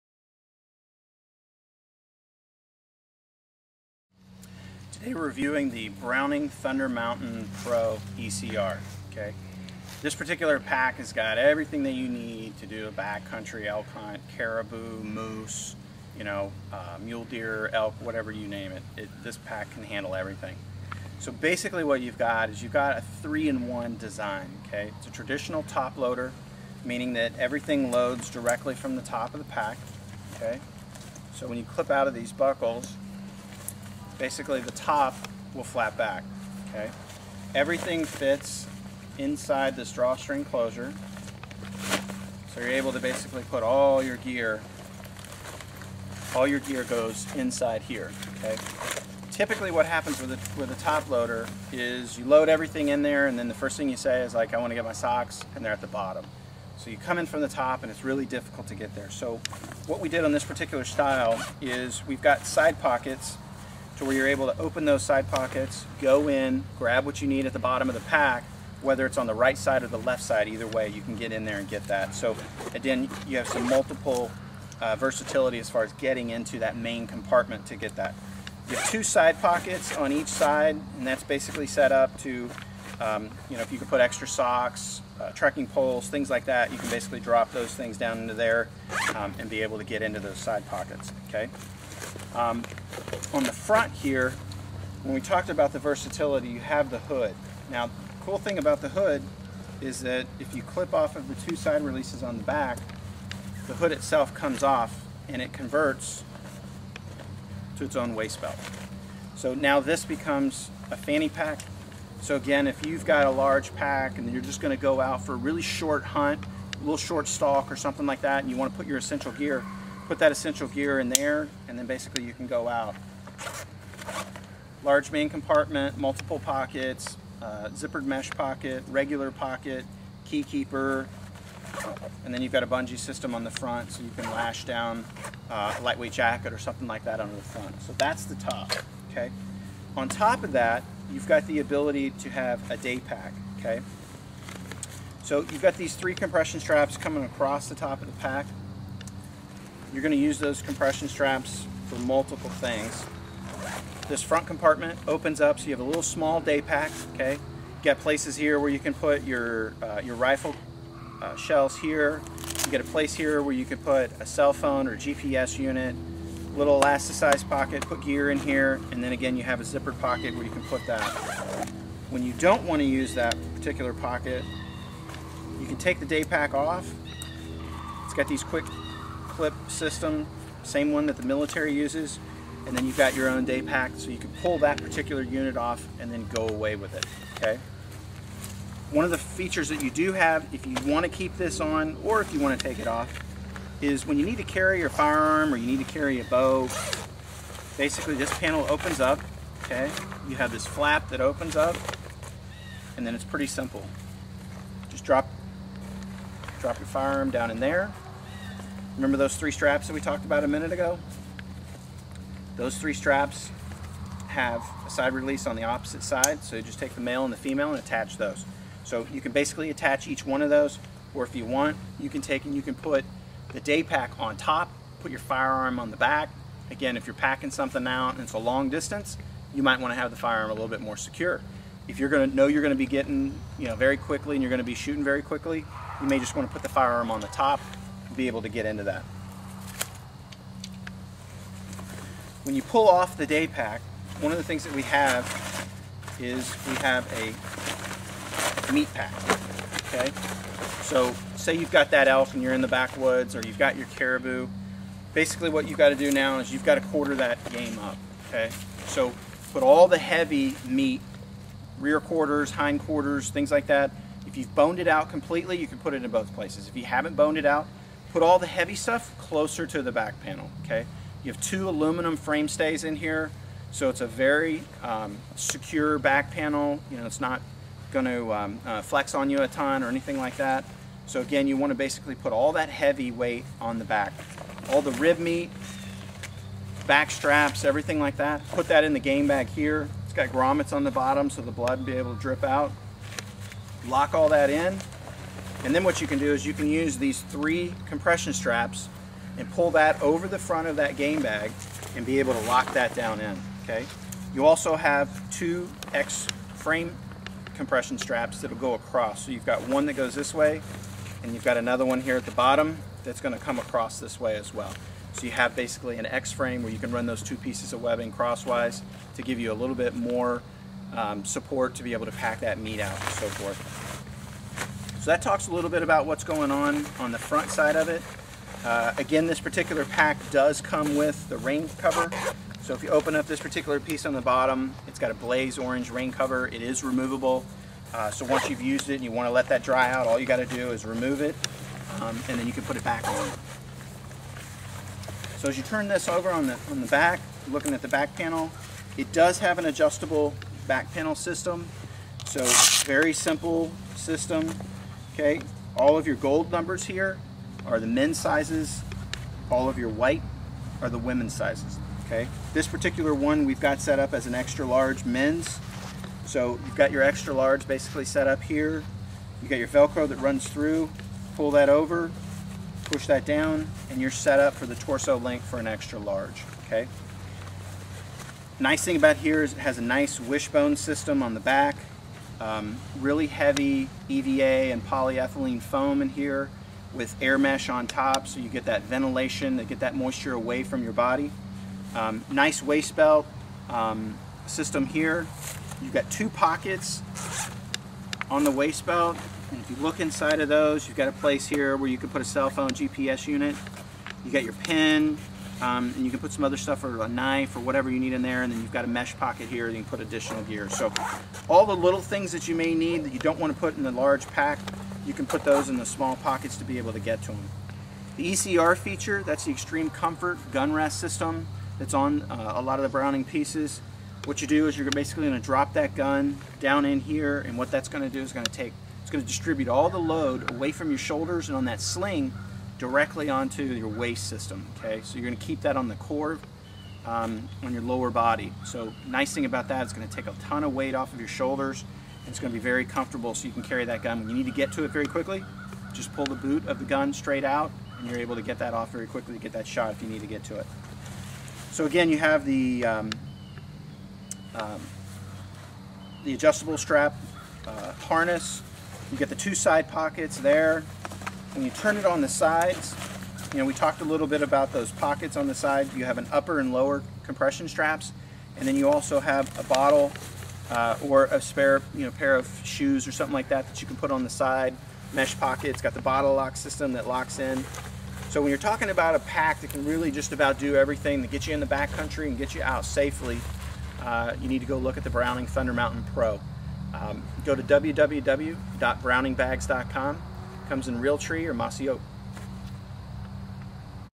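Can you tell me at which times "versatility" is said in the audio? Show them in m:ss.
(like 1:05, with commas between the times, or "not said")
1:14, 1:35.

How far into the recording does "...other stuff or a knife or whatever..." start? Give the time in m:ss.
6:46.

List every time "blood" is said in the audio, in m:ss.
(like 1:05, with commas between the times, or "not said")
4:51.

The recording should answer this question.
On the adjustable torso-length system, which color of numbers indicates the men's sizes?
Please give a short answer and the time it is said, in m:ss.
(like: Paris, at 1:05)
gold, at 5:56.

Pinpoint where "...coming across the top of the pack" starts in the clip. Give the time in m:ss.
2:26.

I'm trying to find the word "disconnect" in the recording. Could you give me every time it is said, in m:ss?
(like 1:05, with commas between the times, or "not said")
not said.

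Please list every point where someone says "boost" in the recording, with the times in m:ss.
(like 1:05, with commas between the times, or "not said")
not said.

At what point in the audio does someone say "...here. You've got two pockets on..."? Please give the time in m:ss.
6:34.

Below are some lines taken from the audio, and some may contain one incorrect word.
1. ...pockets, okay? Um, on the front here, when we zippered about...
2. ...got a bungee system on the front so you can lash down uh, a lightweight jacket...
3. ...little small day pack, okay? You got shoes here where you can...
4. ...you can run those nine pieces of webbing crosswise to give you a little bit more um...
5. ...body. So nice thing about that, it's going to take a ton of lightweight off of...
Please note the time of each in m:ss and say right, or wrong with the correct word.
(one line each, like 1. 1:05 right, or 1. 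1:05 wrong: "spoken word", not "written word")
1. 1:30 wrong: "talked", not "zippered"
2. 2:12 right
3. 2:35 wrong: "places", not "shoes"
4. 5:16 wrong: "two", not "nine"
5. 7:18 wrong: "weight", not "lightweight".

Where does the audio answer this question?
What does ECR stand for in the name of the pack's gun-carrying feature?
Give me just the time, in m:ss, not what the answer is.
6:59.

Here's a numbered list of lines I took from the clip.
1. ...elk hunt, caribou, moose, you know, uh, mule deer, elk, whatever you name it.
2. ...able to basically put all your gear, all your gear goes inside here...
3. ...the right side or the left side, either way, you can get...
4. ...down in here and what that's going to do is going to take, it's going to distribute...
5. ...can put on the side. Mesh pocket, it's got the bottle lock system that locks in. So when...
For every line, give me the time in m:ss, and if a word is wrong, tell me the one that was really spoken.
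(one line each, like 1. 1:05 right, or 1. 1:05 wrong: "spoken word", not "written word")
1. 0:13 right
2. 0:42 right
3. 1:09 right
4. 7:06 right
5. 7:53 right.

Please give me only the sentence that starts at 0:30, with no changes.
Okay, So when you clip out of these buckles, basically the top will flap back, okay?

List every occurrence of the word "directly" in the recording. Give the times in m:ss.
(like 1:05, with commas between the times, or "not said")
0:28, 7:12.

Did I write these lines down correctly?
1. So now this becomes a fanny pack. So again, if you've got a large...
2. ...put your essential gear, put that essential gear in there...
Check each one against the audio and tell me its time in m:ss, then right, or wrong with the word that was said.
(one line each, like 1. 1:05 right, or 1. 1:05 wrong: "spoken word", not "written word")
1. 1:49 right
2. 1:58 right.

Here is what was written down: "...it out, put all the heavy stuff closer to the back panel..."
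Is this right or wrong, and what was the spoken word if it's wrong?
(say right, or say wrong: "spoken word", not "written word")
right.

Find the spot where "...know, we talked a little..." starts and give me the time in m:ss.
7:43.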